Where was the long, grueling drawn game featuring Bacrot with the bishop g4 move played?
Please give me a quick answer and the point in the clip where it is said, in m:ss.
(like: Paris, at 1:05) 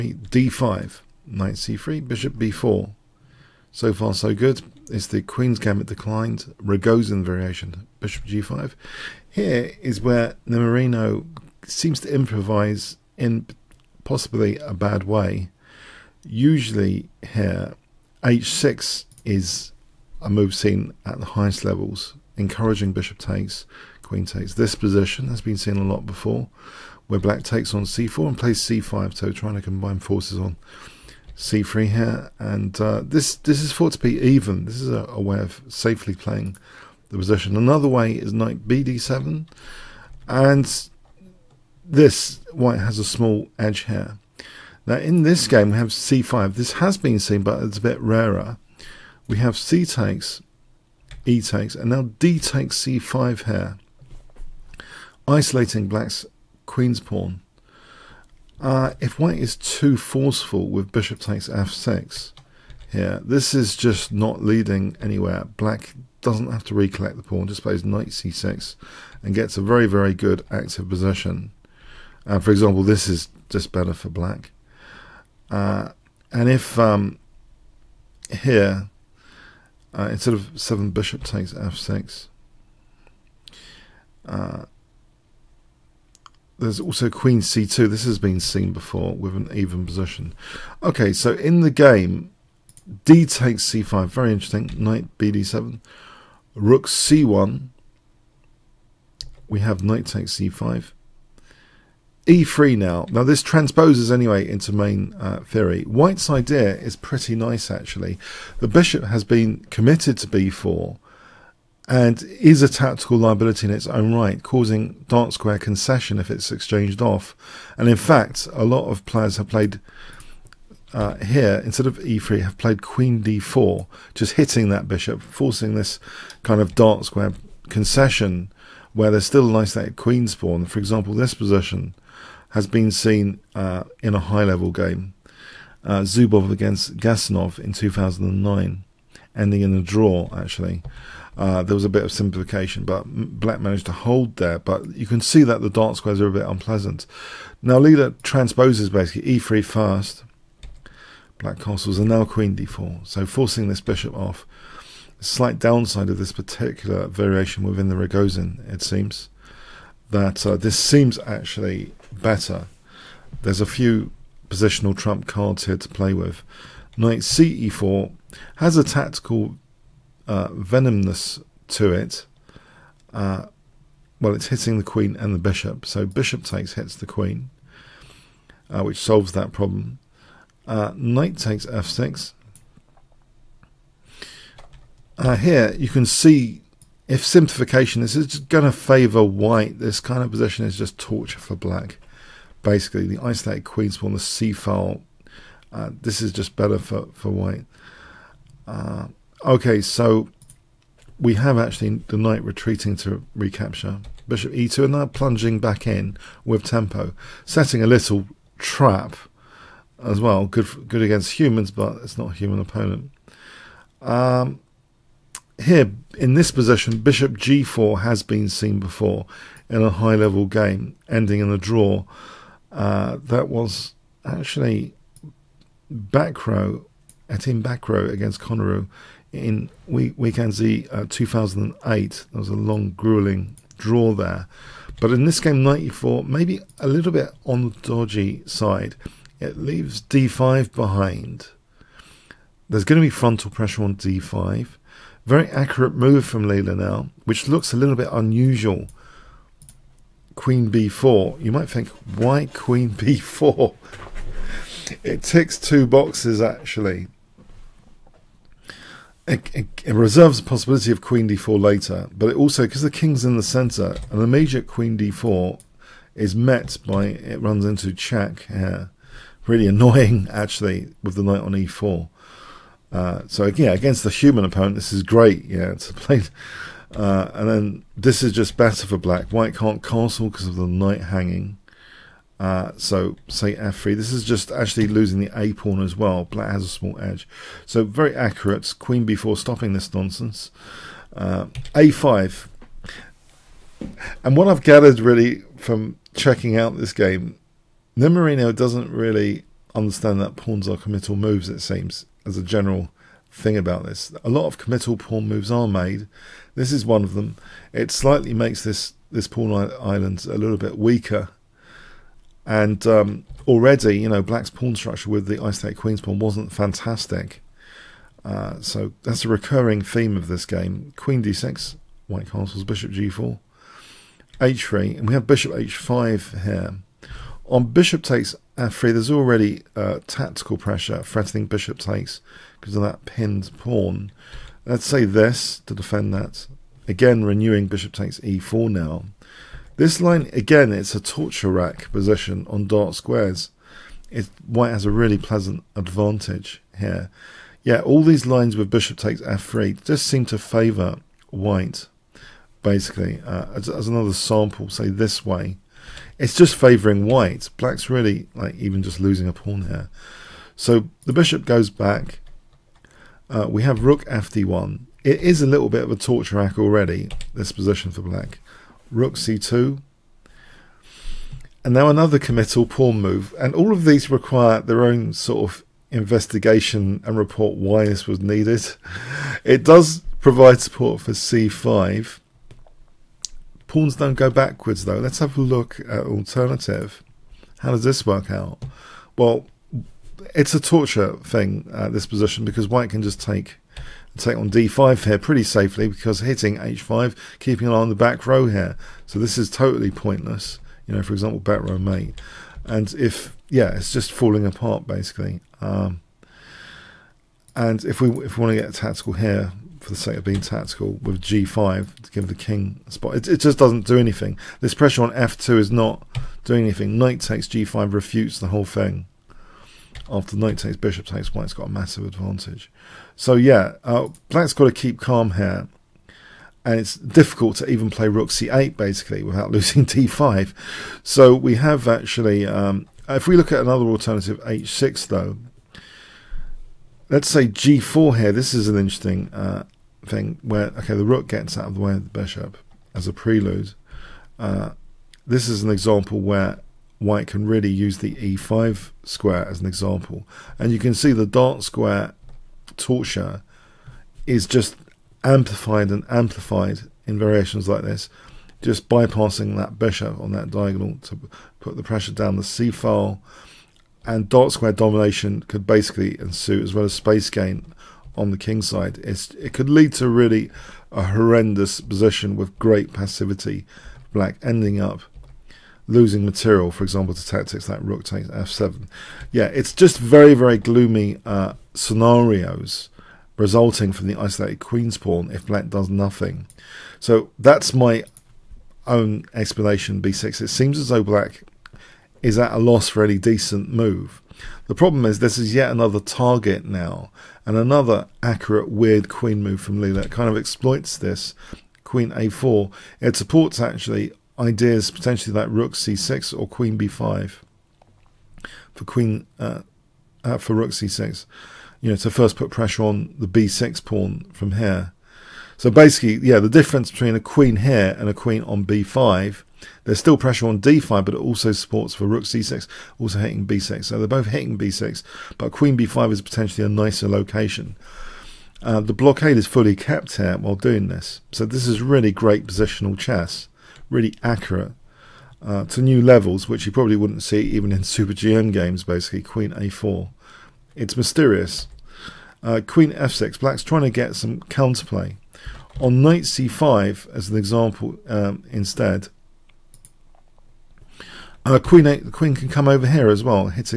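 Wijk aan Zee, at 3:50.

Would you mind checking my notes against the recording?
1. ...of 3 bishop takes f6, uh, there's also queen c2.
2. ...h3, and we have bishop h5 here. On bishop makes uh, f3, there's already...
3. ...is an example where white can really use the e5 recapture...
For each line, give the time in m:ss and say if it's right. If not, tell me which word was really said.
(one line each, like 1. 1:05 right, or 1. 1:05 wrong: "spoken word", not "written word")
1. 1:20 wrong: "7", not "3"
2. 5:24 wrong: "takes", not "makes"
3. 7:25 wrong: "square", not "recapture".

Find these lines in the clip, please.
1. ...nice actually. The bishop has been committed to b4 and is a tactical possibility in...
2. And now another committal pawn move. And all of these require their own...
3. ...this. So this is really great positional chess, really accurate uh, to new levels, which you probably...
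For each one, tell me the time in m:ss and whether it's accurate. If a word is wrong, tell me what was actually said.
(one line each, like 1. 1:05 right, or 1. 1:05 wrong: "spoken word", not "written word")
1. 1:47 wrong: "liability", not "possibility"
2. 6:11 right
3. 8:50 right.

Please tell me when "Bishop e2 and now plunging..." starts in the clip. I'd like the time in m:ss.
3:24.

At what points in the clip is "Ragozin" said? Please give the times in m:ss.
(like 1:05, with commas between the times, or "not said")
0:06, 2:37.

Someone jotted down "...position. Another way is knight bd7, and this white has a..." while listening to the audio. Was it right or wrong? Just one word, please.
right.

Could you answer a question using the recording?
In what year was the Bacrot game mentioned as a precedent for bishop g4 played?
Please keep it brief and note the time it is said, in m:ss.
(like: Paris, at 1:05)
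2008, at 3:51.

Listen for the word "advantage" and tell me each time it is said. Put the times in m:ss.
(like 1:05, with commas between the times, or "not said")
5:45, 7:02.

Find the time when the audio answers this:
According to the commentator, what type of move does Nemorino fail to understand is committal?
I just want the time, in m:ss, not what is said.
5:00.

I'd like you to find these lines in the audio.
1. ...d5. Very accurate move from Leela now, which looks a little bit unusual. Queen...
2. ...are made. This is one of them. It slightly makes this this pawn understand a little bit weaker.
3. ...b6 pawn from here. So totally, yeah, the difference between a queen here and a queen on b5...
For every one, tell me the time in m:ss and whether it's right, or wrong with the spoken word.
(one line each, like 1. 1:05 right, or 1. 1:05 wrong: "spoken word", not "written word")
1. 4:03 right
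2. 5:05 wrong: "island", not "understand"
3. 8:33 wrong: "basically", not "totally".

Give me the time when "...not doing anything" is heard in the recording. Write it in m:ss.
6:55.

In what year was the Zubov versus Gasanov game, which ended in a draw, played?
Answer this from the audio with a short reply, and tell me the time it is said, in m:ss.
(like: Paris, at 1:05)
2009, at 2:17.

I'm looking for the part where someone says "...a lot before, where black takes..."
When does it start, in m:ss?
0:25.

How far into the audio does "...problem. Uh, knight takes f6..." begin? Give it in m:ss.
2:59.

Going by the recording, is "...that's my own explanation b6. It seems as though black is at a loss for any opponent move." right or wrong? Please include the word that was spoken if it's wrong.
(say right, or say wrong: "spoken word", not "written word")
wrong: "decent", not "opponent".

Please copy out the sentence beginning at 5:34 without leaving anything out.
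Let's say this to defend that.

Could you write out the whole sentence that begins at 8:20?
kind of exploits this queen a4.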